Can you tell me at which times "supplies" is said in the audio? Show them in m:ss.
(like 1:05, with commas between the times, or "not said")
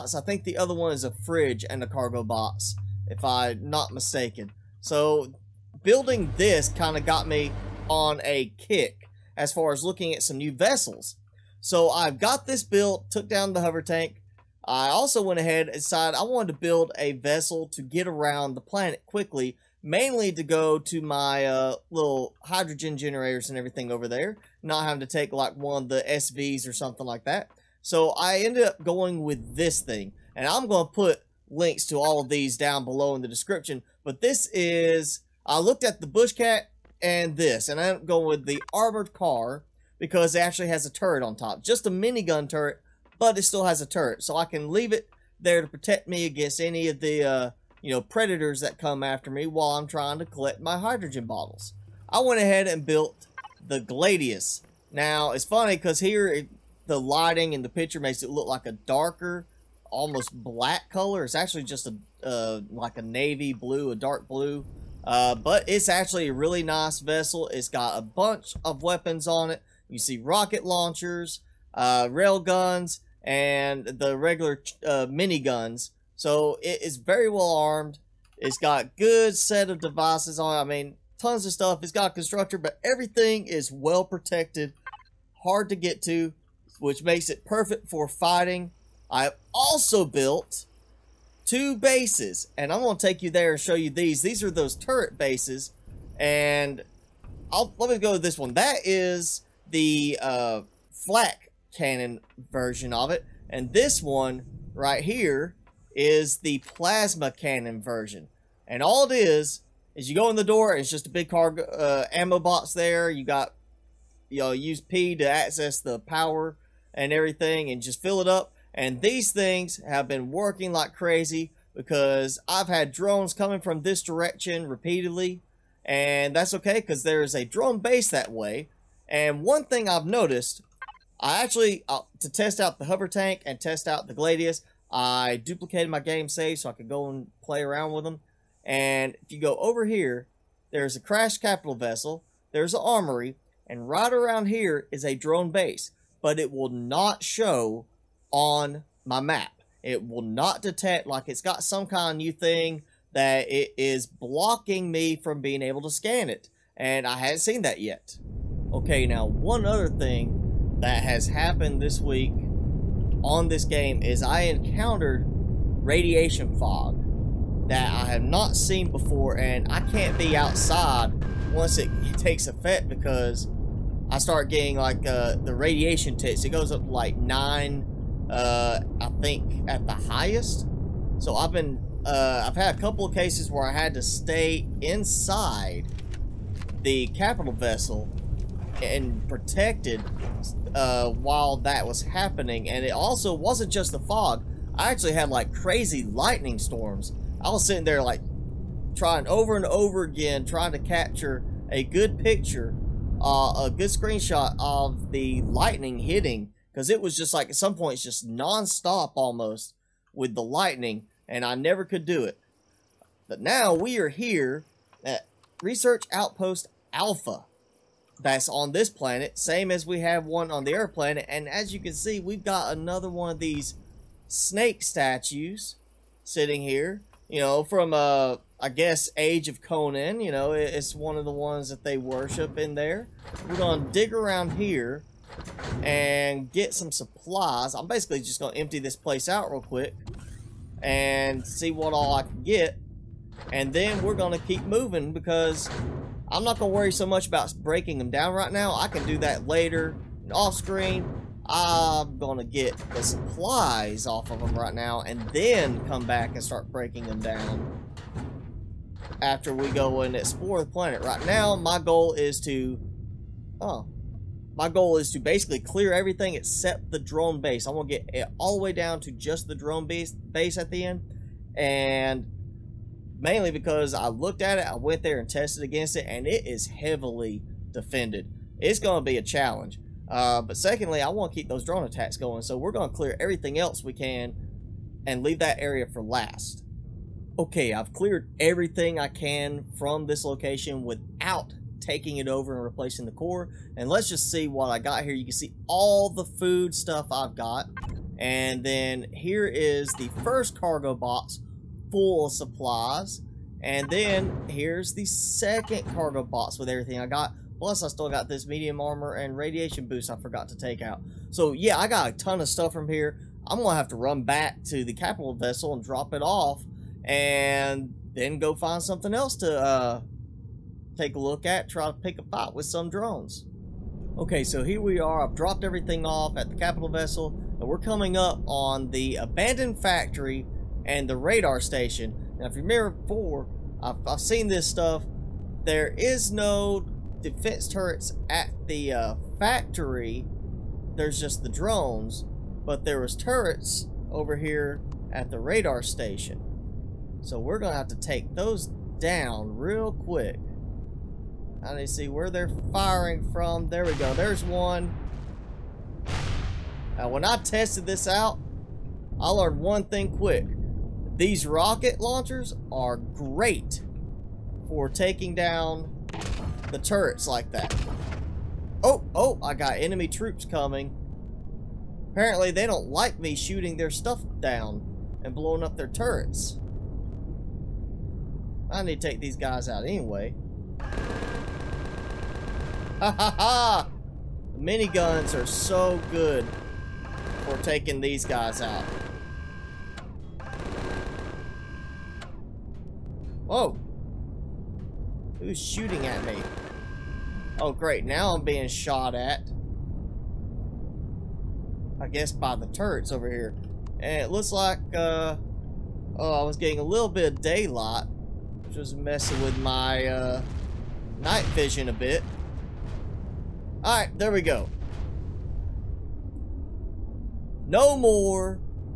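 3:56, 4:13, 5:02.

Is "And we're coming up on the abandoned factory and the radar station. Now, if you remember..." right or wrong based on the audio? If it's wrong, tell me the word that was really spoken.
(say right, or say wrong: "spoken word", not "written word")
right.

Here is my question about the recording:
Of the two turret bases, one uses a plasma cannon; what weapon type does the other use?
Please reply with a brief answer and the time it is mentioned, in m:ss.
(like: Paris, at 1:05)
Flak cannon, at 1:40.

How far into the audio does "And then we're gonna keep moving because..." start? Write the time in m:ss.
4:03.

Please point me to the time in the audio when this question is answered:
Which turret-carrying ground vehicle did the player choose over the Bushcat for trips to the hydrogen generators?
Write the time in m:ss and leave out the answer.
0:38.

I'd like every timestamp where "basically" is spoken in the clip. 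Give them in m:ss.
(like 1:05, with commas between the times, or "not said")
3:57, 4:25.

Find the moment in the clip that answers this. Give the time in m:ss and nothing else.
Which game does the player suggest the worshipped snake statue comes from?
3:49.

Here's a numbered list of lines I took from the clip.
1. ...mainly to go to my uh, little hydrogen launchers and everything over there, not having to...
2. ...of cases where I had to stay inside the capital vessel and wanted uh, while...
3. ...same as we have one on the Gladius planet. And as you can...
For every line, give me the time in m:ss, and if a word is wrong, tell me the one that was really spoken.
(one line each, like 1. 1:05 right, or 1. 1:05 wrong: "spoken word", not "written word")
1. 0:19 wrong: "generators", not "launchers"
2. 3:03 wrong: "protected", not "wanted"
3. 3:39 wrong: "Earth", not "Gladius".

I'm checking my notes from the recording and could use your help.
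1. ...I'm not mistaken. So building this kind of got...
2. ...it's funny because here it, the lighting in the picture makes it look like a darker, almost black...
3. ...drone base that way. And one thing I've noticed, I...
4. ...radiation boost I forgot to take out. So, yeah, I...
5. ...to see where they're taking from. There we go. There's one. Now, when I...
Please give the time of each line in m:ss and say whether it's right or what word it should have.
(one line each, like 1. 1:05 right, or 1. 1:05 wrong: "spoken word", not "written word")
1. 0:03 right
2. 0:55 right
3. 2:07 right
4. 5:09 right
5. 5:51 wrong: "firing", not "taking".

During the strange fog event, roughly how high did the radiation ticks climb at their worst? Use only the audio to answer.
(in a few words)
9.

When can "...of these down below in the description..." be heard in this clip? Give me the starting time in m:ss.
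0:32.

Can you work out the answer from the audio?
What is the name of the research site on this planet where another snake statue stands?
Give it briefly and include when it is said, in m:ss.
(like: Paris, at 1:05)
Research Outpost Alpha, at 3:35.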